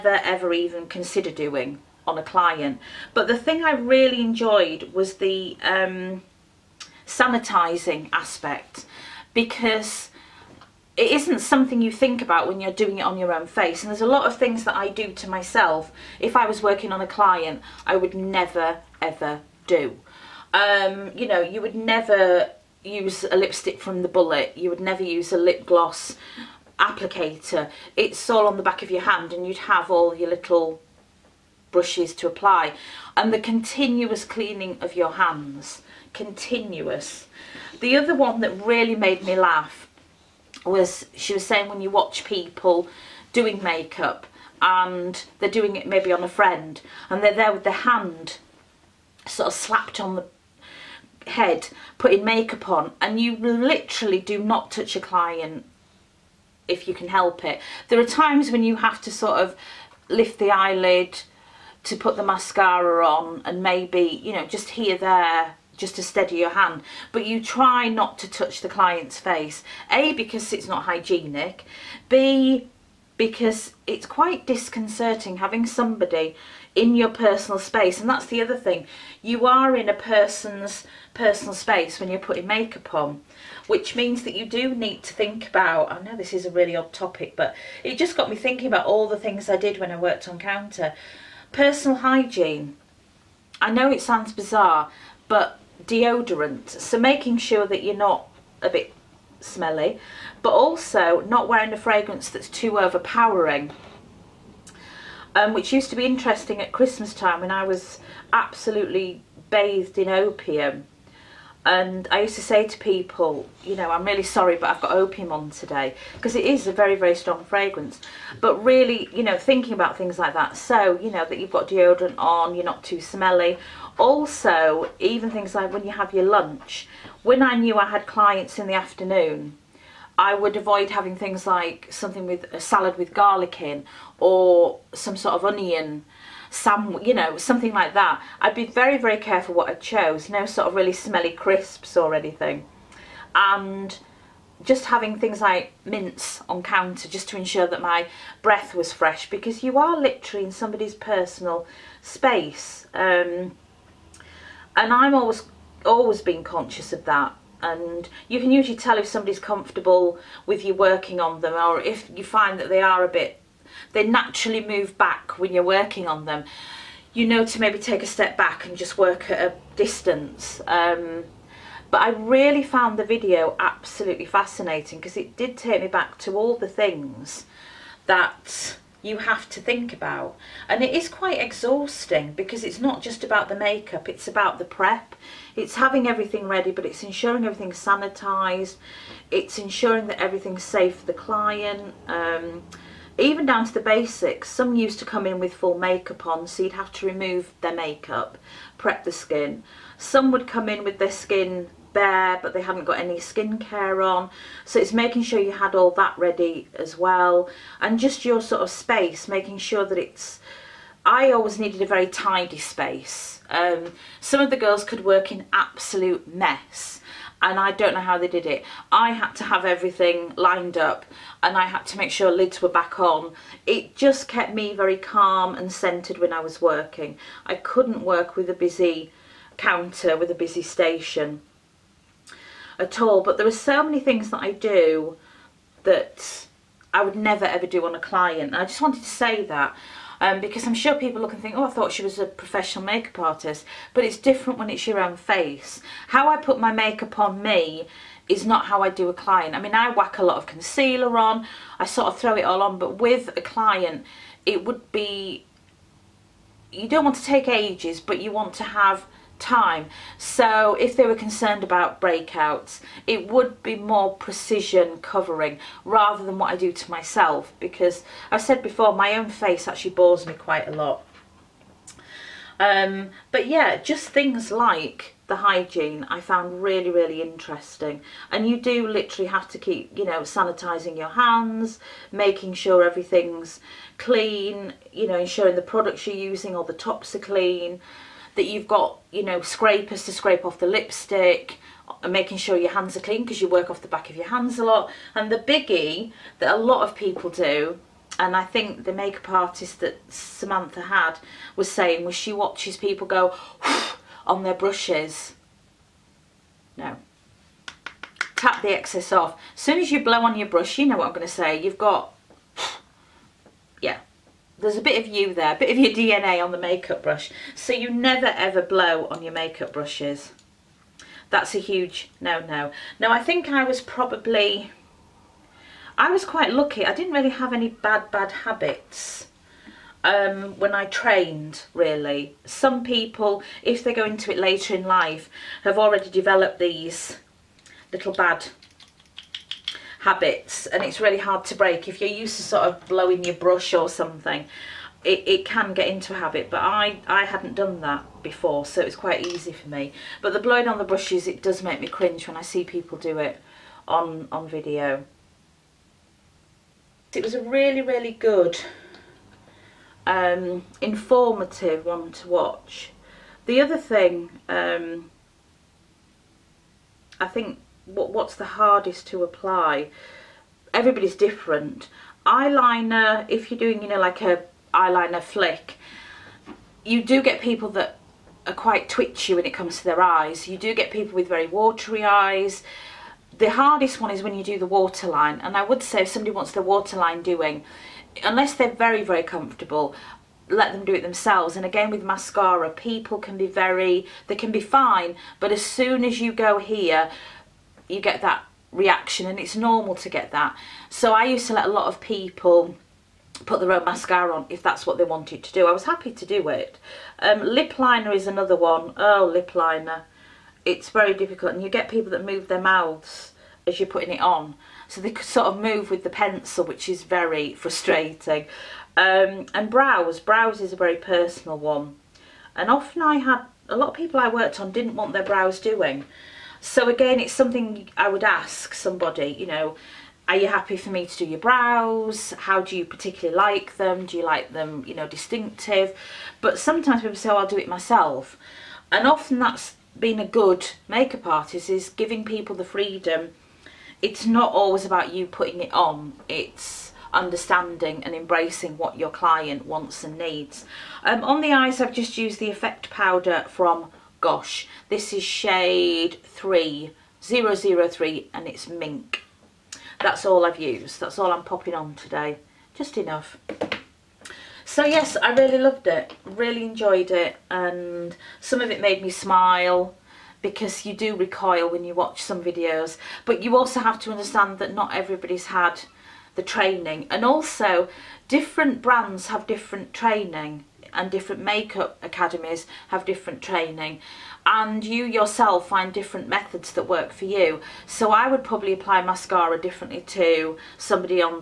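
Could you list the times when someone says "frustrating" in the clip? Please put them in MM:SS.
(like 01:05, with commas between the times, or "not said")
06:57.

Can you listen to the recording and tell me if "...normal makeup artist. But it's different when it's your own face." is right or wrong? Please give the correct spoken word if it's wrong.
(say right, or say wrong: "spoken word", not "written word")
wrong: "professional", not "normal".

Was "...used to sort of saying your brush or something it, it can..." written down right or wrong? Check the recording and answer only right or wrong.
wrong.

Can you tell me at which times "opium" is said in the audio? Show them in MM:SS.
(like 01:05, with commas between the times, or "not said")
01:50, 01:54.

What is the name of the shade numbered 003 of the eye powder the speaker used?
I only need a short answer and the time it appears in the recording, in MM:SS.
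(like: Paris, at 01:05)
Mink, at 07:38.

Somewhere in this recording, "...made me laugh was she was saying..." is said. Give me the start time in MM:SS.
00:38.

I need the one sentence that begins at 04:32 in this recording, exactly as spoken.
Um, but yeah, just things like the hygiene I found really, really interesting.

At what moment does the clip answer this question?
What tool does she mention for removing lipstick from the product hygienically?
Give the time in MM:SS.
04:49.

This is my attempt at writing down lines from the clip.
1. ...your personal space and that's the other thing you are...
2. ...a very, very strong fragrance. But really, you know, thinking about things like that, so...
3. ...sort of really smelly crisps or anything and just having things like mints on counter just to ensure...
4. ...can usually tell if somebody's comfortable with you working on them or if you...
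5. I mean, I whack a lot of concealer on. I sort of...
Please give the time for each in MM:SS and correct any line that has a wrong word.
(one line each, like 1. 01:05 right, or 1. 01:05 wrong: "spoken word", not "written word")
1. 01:16 right
2. 01:56 right
3. 02:20 right
4. 02:38 right
5. 04:09 right.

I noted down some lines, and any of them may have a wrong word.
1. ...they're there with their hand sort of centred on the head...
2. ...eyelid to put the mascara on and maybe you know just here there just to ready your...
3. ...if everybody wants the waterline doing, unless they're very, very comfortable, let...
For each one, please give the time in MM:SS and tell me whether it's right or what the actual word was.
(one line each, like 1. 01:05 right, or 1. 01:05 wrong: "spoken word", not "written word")
1. 00:47 wrong: "slapped", not "centred"
2. 01:00 wrong: "steady", not "ready"
3. 06:26 wrong: "somebody", not "everybody".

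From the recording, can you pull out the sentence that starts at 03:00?
And it is quite exhausting because it's not just about the makeup, it's about the prep.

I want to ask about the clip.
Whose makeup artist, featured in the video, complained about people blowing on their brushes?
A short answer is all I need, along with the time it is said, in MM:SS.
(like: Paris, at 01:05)
Samantha, at 05:00.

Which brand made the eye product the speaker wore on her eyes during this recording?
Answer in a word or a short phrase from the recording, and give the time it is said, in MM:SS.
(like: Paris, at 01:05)
Gosh, at 07:34.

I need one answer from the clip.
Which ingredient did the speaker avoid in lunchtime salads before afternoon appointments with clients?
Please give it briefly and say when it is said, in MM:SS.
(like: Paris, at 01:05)
Garlic, at 02:13.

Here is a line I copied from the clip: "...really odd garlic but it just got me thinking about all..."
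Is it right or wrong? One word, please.
wrong.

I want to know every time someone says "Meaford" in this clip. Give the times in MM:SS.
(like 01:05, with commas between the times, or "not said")
not said.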